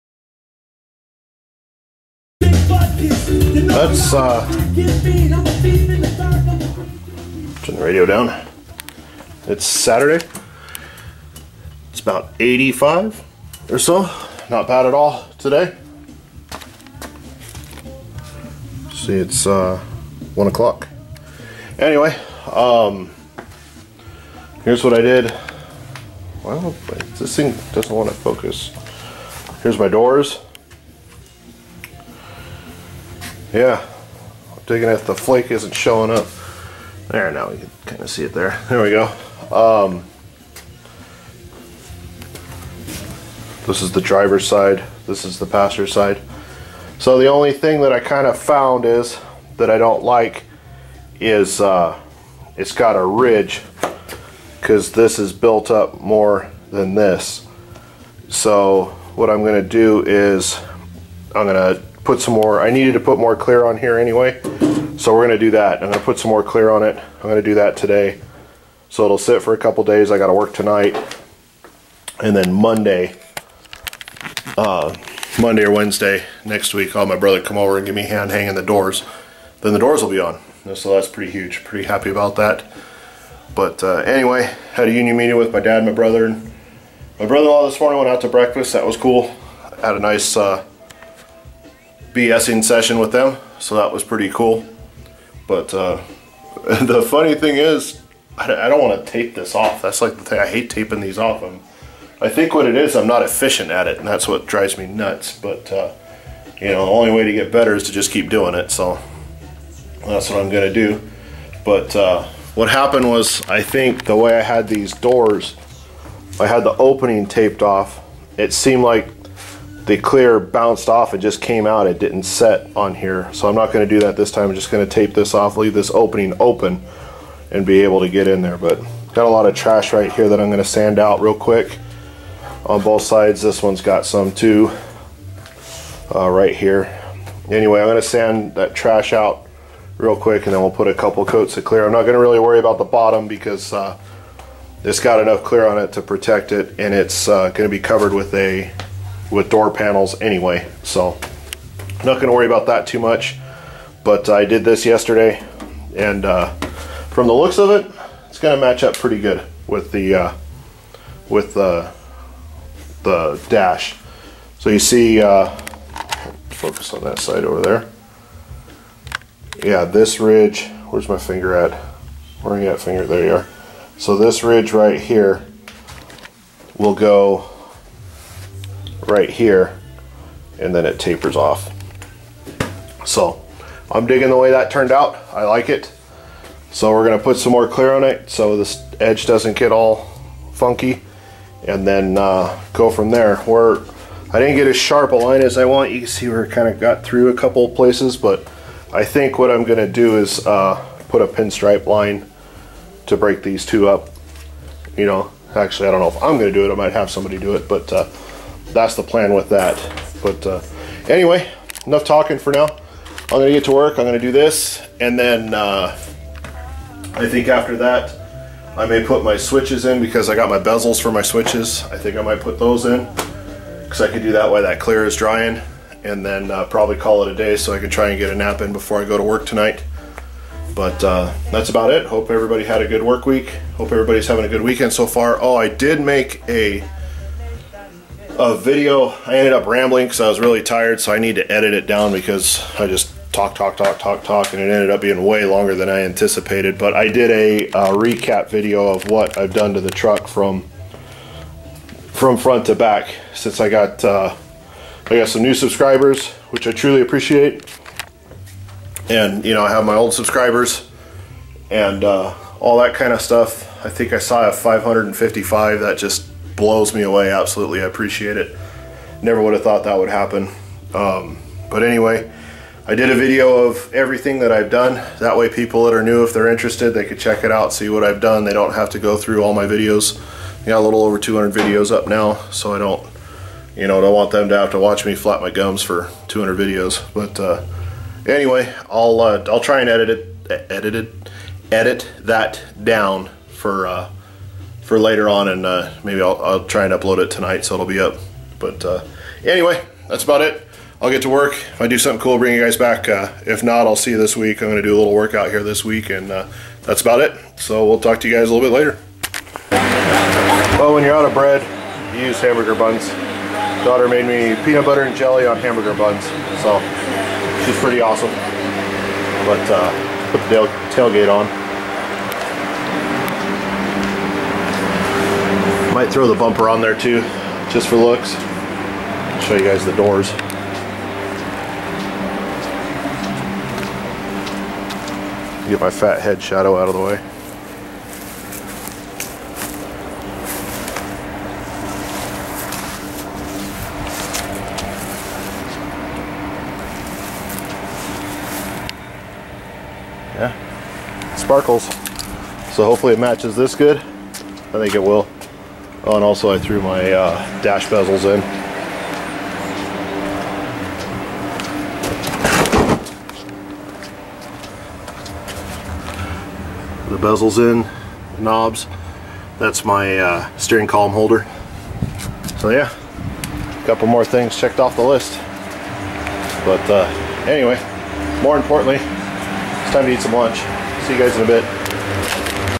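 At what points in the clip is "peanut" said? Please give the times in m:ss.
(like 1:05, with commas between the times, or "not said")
5:14.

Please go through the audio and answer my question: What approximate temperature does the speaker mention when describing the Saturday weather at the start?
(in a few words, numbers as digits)
85.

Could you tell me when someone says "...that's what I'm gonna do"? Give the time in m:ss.
1:50.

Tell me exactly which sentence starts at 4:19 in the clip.
And you know, I have my old subscribers and uh, all that kind of stuff.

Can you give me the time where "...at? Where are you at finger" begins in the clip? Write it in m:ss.
2:51.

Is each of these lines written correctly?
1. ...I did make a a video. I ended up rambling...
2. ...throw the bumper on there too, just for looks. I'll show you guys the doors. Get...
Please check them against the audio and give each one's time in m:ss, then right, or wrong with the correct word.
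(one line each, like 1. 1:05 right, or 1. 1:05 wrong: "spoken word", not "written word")
1. 3:55 right
2. 5:26 right.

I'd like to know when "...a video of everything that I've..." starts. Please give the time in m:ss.
4:33.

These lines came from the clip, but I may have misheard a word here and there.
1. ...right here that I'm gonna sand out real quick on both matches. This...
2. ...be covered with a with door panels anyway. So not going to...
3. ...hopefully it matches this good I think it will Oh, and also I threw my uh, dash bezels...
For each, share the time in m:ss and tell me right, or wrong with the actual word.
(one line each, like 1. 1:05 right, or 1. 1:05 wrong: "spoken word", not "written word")
1. 2:09 wrong: "sides", not "matches"
2. 2:27 right
3. 5:52 right.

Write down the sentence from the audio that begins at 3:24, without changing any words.
You know, actually I don't know if I'm gonna do it.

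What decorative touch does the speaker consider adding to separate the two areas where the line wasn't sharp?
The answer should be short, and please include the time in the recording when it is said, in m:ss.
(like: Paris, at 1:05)
pinstripe line, at 3:21.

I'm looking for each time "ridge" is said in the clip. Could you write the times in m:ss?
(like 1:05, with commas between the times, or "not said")
0:53, 2:50, 2:54.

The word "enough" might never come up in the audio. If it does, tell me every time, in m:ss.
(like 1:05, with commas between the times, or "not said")
2:25, 3:31.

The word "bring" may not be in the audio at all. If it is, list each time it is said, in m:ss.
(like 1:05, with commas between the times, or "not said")
5:02.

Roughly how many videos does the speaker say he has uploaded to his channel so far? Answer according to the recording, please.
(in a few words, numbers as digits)
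a little over 200.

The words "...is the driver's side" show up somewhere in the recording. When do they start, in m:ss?
0:43.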